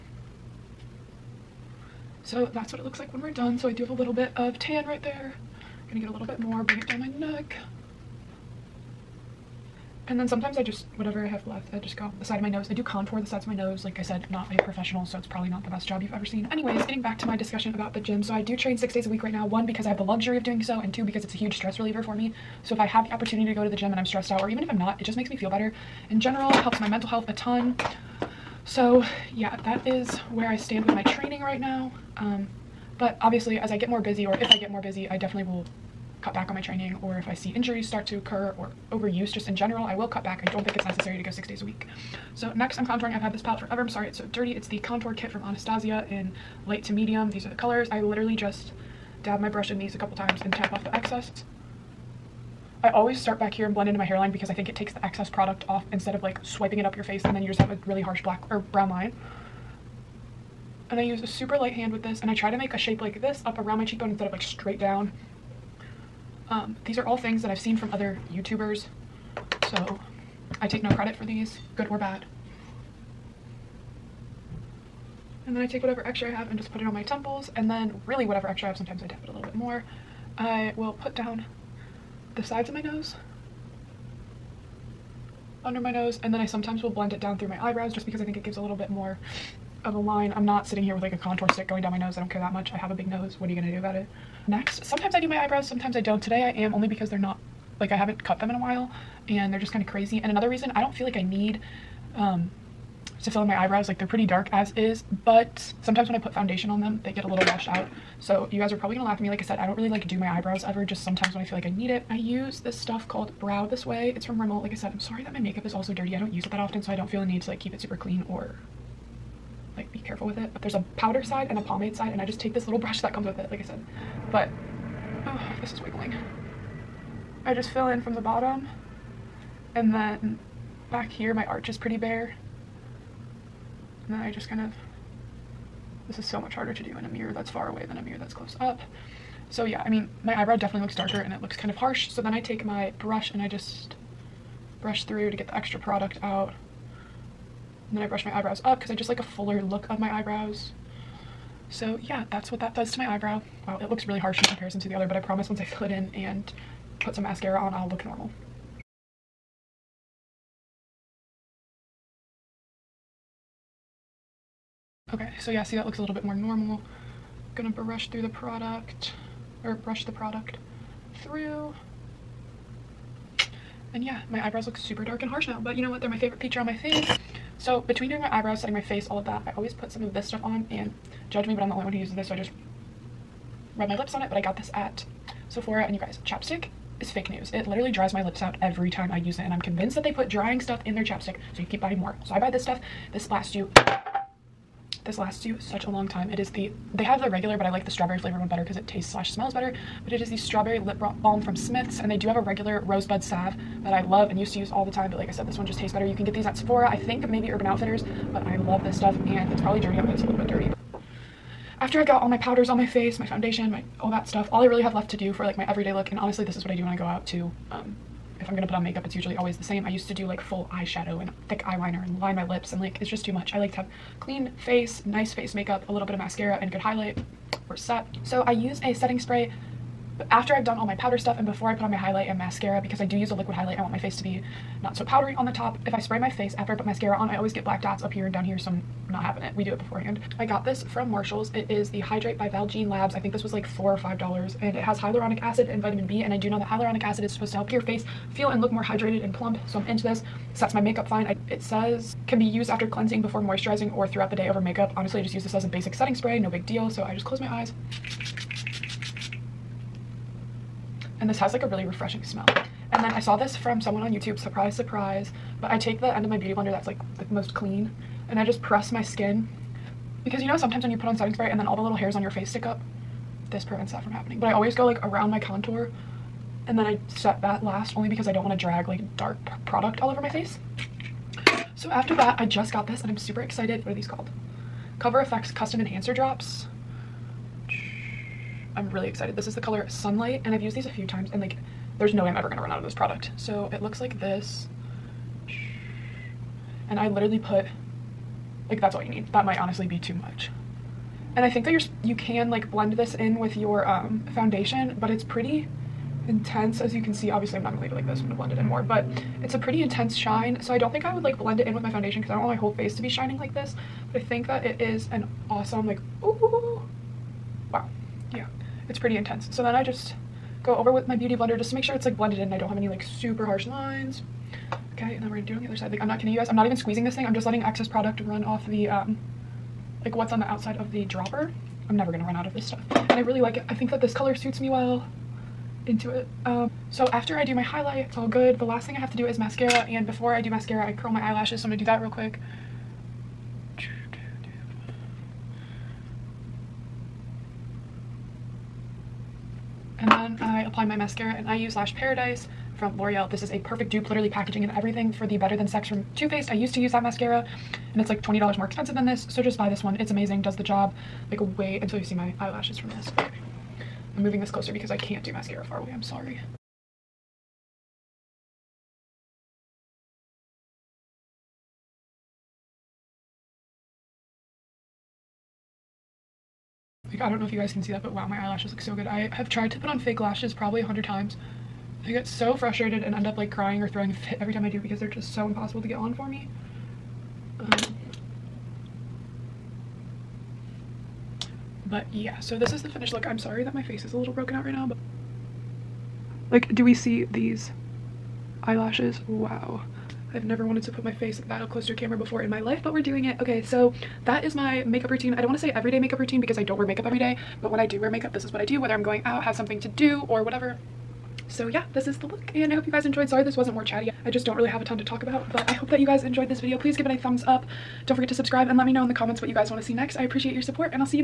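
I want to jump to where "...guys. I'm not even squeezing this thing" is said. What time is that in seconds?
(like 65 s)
326 s.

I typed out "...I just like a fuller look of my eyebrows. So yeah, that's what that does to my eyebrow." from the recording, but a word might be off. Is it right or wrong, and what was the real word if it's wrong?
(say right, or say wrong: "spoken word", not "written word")
right.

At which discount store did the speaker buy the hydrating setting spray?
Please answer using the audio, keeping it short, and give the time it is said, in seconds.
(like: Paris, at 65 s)
Marshall's, at 241 s.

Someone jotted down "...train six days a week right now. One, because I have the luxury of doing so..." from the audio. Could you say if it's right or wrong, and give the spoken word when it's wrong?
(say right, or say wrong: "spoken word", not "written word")
right.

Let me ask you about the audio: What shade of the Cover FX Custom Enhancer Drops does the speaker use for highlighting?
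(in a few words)
Sunlight.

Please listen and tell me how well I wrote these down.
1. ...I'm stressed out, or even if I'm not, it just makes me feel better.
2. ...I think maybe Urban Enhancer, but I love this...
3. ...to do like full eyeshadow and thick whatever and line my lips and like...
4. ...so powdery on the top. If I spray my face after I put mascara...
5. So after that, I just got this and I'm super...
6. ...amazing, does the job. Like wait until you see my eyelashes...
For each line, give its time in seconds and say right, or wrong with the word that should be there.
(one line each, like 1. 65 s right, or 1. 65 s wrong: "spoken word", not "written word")
1. 23 s right
2. 206 s wrong: "Outfitters", not "Enhancer"
3. 220 s wrong: "eyeliner", not "whatever"
4. 234 s right
5. 281 s right
6. 360 s right.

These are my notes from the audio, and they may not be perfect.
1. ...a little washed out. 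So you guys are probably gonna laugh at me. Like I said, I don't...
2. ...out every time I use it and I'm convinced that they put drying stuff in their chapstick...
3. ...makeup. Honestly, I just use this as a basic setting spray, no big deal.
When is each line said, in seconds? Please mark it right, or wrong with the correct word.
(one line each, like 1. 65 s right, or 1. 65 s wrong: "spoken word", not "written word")
1. 107 s right
2. 188 s right
3. 254 s right.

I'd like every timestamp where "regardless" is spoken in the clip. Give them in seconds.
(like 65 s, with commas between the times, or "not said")
not said.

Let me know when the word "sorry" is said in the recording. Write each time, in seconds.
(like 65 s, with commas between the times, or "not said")
43 s, 115 s, 366 s, 393 s, 413 s.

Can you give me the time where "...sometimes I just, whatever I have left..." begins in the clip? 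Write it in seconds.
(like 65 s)
10 s.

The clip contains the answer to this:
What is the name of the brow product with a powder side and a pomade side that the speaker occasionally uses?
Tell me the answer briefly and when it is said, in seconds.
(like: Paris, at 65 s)
Brow This Way, at 113 s.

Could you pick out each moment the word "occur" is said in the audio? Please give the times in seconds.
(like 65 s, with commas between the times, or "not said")
38 s.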